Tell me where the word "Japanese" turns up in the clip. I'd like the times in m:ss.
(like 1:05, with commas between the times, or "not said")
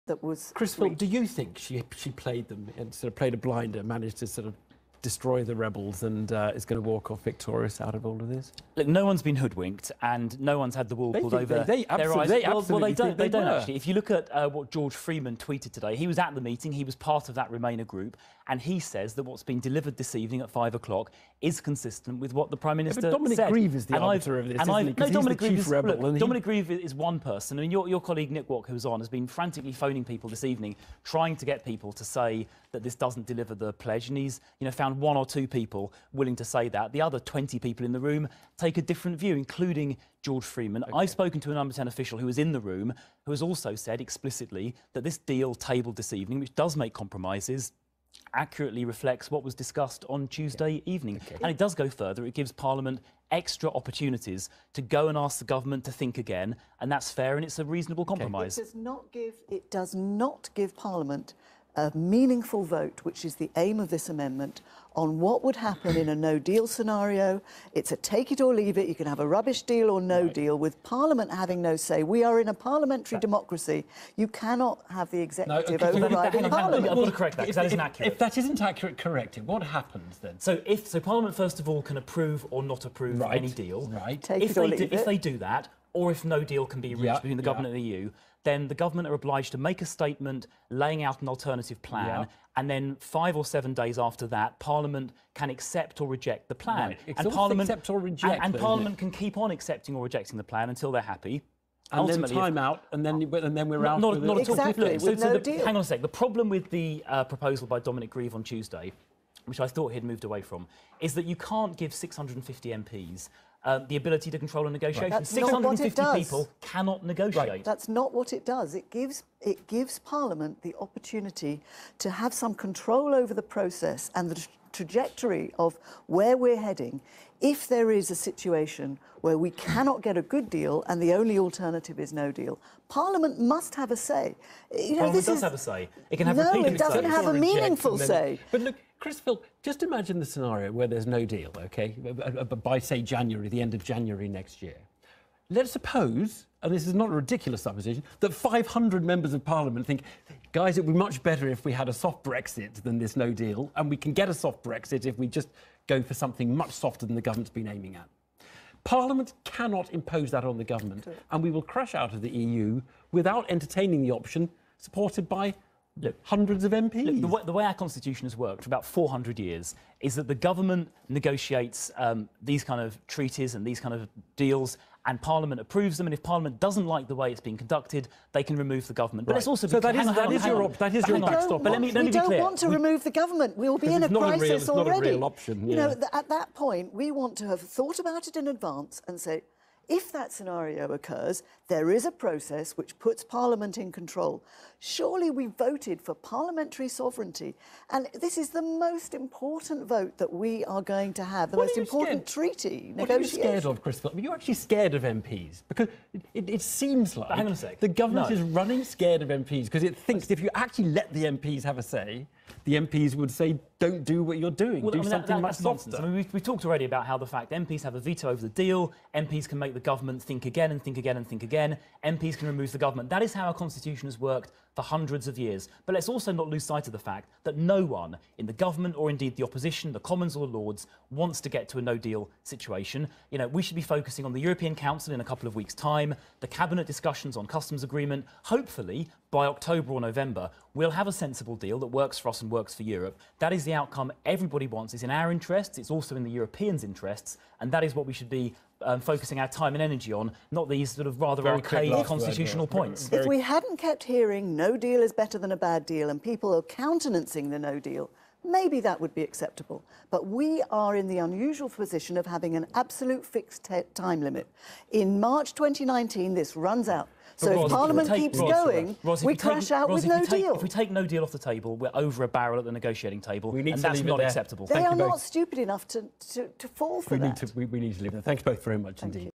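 not said.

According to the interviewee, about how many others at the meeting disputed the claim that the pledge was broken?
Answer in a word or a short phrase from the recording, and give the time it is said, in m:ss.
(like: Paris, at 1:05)
20, at 0:37.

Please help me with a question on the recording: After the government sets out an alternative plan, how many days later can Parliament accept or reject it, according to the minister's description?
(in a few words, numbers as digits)
5 or 7.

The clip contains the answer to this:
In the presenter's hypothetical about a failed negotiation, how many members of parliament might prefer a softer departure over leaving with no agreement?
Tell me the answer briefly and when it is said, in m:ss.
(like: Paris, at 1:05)
500, at 2:28.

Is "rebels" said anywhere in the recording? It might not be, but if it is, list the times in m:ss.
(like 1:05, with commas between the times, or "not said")
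0:05, 0:25.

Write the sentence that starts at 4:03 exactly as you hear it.
That is the outcome everybody wants.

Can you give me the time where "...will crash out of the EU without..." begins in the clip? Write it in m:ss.
2:41.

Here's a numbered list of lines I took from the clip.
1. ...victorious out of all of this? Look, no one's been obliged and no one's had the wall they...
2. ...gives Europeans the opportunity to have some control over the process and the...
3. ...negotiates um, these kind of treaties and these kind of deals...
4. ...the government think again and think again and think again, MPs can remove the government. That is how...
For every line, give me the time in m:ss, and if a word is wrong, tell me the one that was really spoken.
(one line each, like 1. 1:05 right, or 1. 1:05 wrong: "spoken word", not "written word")
1. 0:07 wrong: "hoodwinked", not "obliged"
2. 1:59 wrong: "Parliament", not "Europeans"
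3. 2:51 right
4. 3:39 right.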